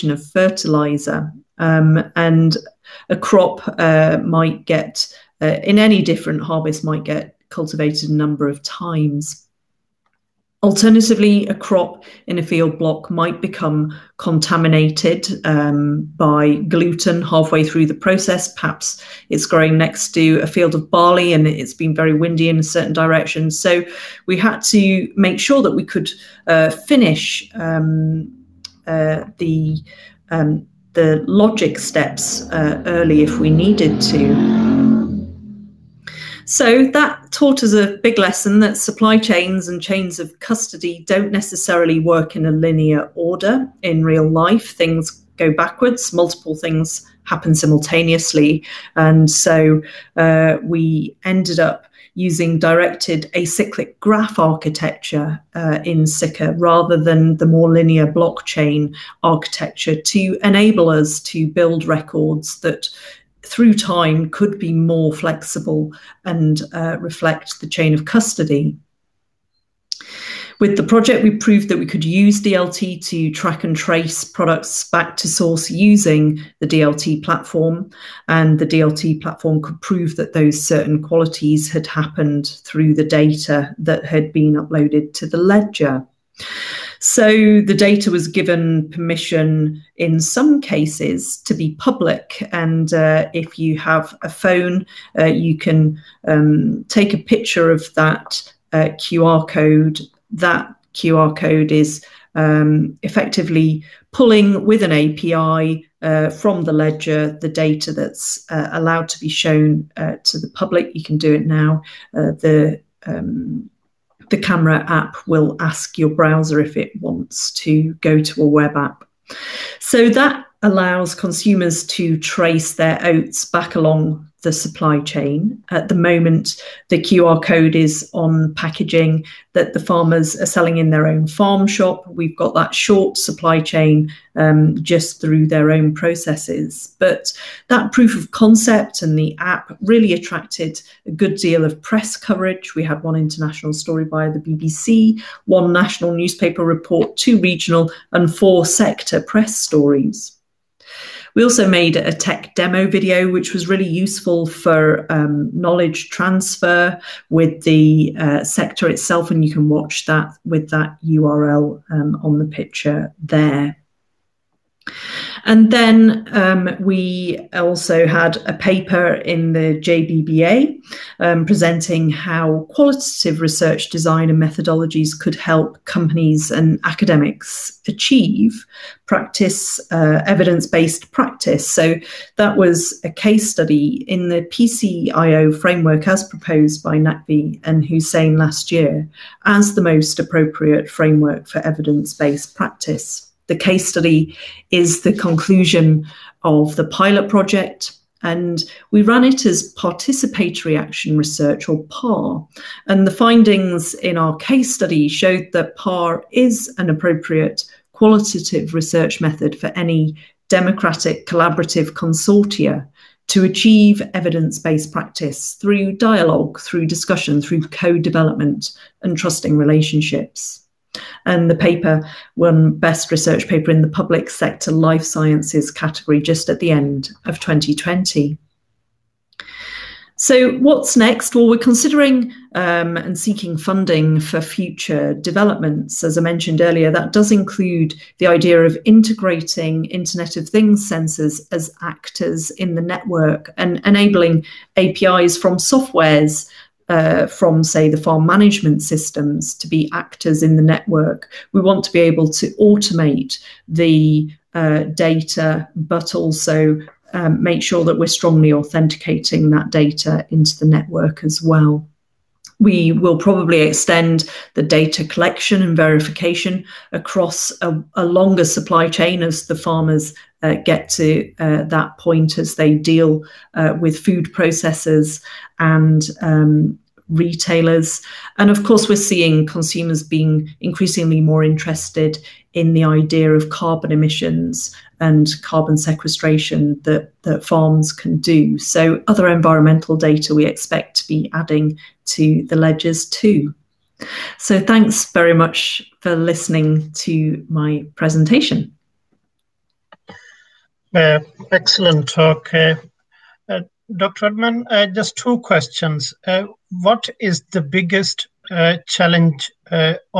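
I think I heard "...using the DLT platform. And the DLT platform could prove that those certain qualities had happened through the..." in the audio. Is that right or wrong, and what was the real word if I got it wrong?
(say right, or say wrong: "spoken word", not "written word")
right.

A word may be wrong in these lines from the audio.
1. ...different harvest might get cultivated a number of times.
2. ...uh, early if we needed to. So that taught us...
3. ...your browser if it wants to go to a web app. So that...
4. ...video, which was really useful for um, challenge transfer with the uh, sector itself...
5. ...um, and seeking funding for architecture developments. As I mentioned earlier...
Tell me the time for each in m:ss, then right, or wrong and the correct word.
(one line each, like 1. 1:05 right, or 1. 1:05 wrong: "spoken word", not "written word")
1. 0:06 right
2. 0:32 right
3. 1:55 right
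4. 2:32 wrong: "knowledge", not "challenge"
5. 3:52 wrong: "future", not "architecture".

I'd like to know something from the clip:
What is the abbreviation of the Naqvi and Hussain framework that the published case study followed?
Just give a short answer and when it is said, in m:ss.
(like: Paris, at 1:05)
PCIO, at 3:04.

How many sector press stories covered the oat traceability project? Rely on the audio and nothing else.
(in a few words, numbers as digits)
4.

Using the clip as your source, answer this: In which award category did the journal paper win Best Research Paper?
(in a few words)
Public Sector Life Sciences.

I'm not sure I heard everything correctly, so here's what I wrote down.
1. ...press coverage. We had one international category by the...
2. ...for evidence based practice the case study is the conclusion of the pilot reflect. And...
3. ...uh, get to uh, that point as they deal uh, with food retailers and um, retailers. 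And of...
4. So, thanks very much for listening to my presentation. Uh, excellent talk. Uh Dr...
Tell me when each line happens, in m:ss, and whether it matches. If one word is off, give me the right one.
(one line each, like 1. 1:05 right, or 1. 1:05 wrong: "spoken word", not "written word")
1. 2:21 wrong: "story", not "category"
2. 3:11 wrong: "project", not "reflect"
3. 4:30 wrong: "processors", not "retailers"
4. 4:54 right.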